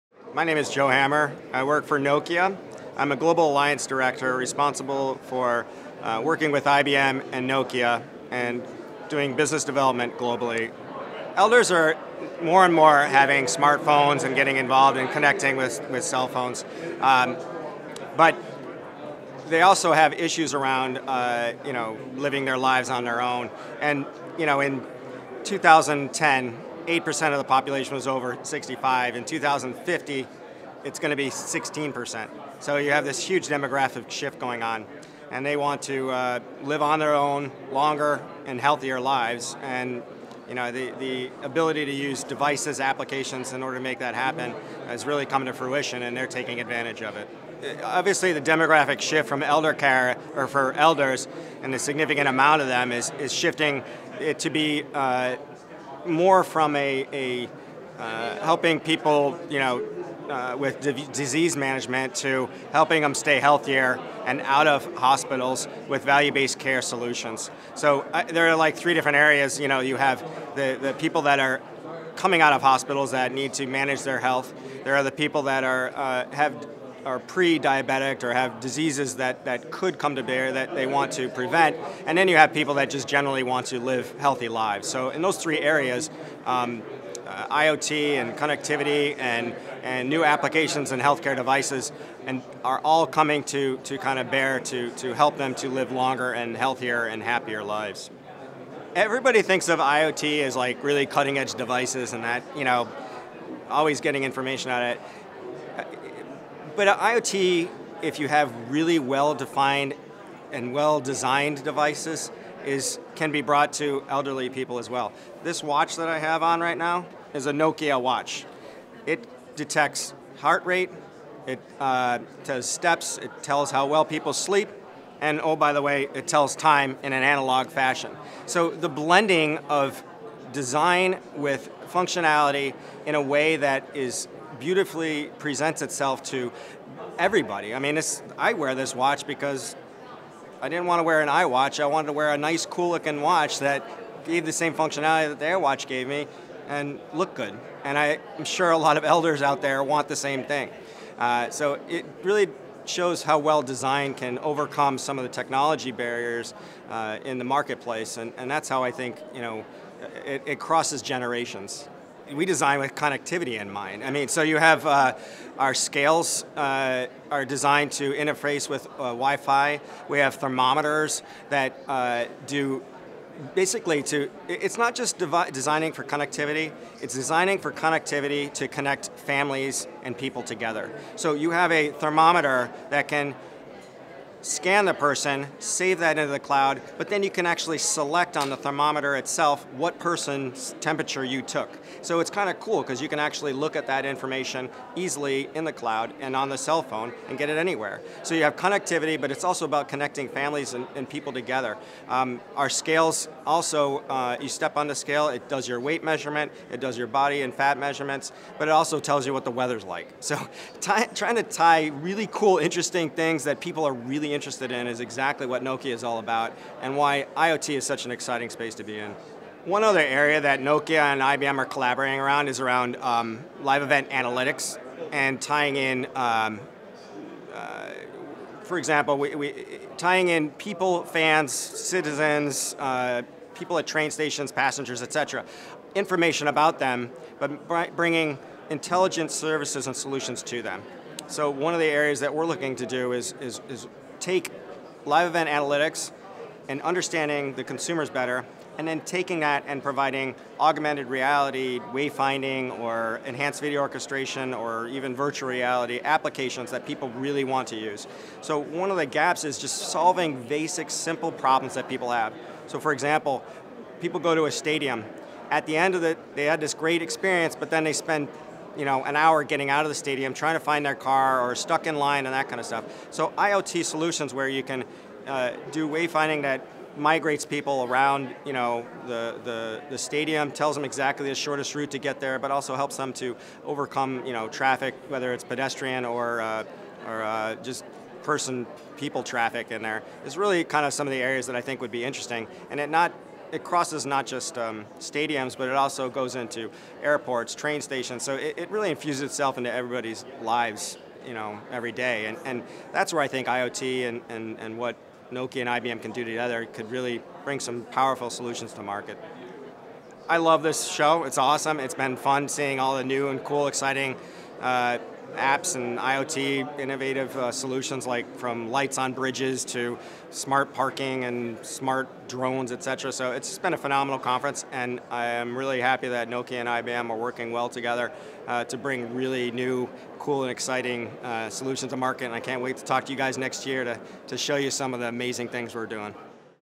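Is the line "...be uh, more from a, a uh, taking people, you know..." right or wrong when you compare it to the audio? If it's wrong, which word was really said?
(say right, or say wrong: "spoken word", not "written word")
wrong: "helping", not "taking".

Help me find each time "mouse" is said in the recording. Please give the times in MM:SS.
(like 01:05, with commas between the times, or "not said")
not said.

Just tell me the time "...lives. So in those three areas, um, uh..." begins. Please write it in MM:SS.
01:24.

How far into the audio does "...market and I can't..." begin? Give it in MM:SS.
05:31.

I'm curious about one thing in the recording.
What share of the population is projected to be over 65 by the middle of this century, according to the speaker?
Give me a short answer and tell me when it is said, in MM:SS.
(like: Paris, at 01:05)
16%, at 00:31.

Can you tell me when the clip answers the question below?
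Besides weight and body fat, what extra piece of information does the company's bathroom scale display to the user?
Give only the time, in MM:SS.
03:29.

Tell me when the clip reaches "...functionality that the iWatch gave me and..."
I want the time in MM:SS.
02:24.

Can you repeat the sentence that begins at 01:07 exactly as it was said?
So uh, there are like three different areas.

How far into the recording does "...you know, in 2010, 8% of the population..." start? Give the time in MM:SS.
00:24.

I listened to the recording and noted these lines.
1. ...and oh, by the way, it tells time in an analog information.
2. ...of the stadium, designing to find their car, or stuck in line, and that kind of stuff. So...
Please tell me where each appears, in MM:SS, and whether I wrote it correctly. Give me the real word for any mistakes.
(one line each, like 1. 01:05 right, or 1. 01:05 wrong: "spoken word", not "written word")
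1. 02:05 wrong: "fashion", not "information"
2. 04:29 wrong: "trying", not "designing".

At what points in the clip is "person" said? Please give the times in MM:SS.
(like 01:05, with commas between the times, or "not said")
03:04, 03:09, 04:48.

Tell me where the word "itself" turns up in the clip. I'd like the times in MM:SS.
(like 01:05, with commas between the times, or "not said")
02:15, 03:09, 04:59.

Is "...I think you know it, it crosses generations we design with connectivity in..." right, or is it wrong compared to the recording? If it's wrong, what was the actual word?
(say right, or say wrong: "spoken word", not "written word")
right.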